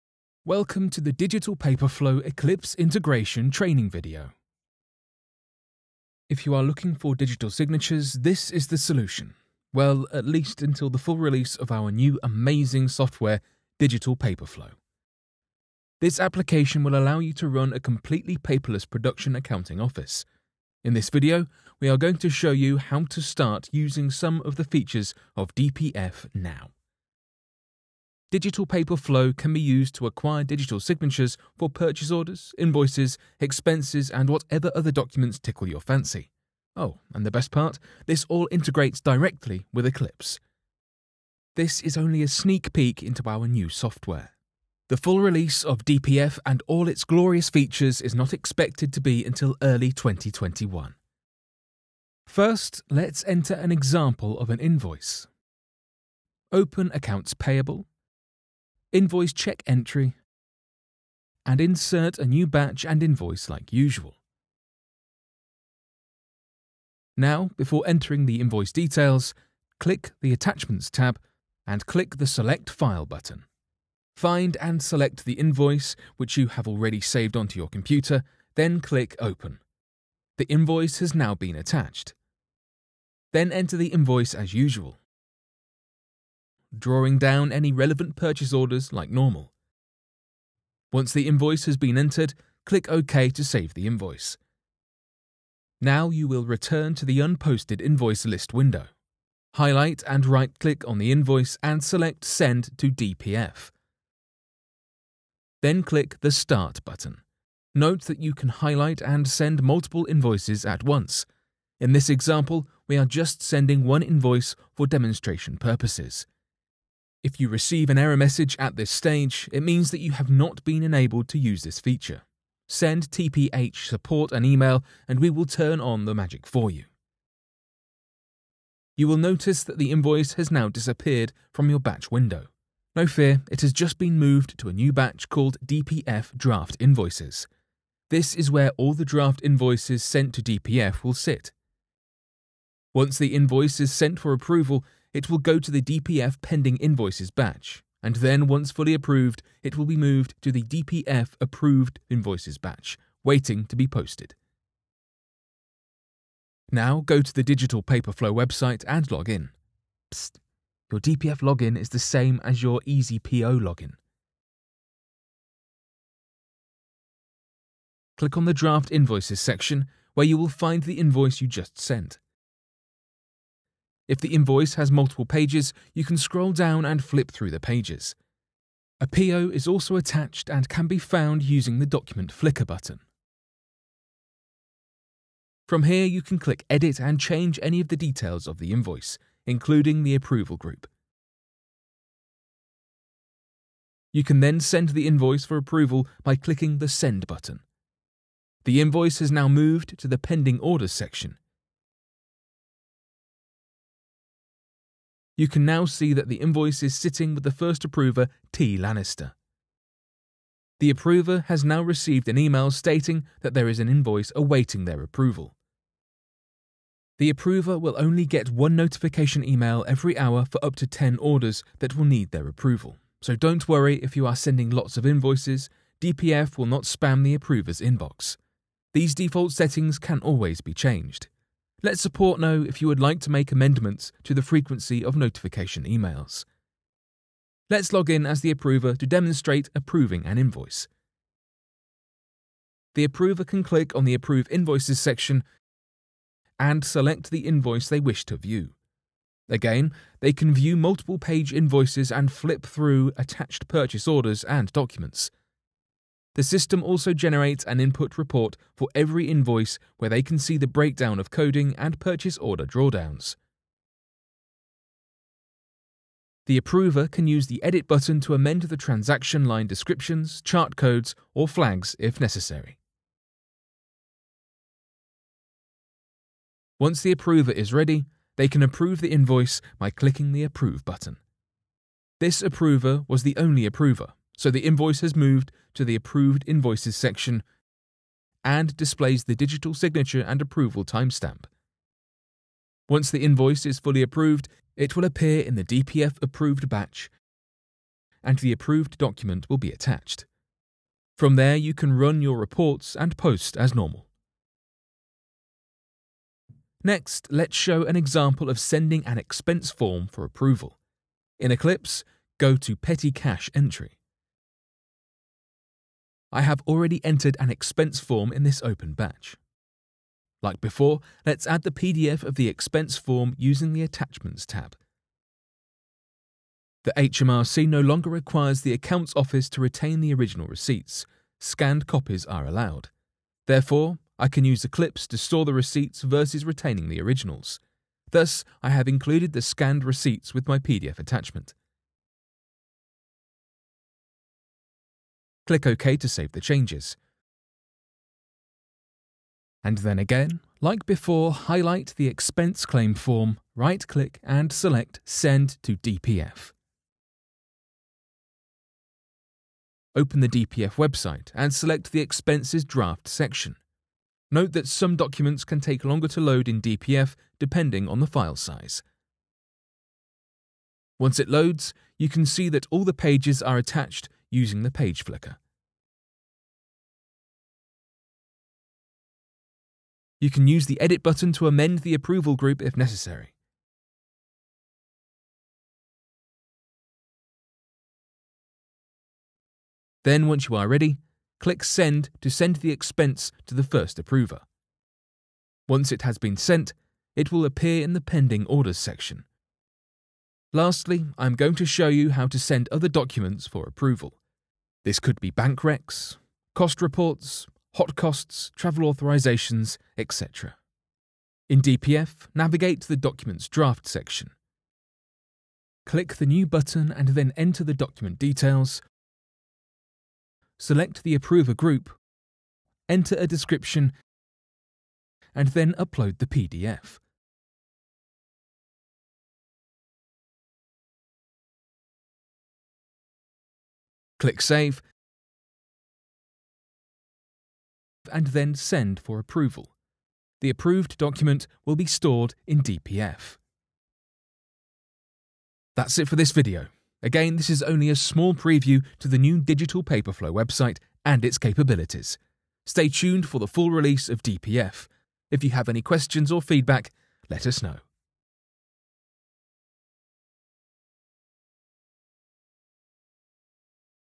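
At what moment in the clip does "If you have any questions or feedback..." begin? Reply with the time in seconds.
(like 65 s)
455 s.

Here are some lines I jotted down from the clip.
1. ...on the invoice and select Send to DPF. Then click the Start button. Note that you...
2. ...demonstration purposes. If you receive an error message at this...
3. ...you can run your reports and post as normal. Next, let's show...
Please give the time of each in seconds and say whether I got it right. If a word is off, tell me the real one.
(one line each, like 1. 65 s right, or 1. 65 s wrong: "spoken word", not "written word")
1. 100 s right
2. 114 s right
3. 301 s right.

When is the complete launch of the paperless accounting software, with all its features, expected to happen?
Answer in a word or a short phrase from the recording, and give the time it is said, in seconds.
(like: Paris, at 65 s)
early 2021, at 49 s.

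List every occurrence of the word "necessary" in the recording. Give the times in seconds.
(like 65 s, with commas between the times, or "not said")
272 s, 382 s.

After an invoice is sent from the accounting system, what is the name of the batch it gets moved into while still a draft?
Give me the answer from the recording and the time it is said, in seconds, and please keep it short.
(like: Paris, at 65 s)
DPF Draft Invoices, at 135 s.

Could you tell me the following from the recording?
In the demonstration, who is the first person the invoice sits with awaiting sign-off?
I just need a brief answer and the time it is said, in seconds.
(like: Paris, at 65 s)
T. Lannister, at 208 s.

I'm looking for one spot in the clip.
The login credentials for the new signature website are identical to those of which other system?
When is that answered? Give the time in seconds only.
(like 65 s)
162 s.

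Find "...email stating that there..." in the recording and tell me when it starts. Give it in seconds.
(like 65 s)
212 s.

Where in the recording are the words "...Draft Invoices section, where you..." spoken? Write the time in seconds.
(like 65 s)
168 s.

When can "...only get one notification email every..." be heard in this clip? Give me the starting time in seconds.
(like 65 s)
217 s.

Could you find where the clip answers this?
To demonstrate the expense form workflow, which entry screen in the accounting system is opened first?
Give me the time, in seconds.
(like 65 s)
312 s.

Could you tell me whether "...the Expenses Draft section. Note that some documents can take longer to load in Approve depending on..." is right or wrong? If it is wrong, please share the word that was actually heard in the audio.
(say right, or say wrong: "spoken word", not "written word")
wrong: "DPF", not "Approve".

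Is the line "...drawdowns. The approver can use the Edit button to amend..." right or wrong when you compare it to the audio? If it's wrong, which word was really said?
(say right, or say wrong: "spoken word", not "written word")
right.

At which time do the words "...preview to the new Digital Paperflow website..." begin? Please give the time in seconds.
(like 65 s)
448 s.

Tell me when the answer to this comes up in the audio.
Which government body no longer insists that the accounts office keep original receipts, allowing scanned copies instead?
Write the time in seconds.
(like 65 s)
326 s.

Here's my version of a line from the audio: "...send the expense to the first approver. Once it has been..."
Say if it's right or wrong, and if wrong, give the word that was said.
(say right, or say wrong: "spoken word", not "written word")
right.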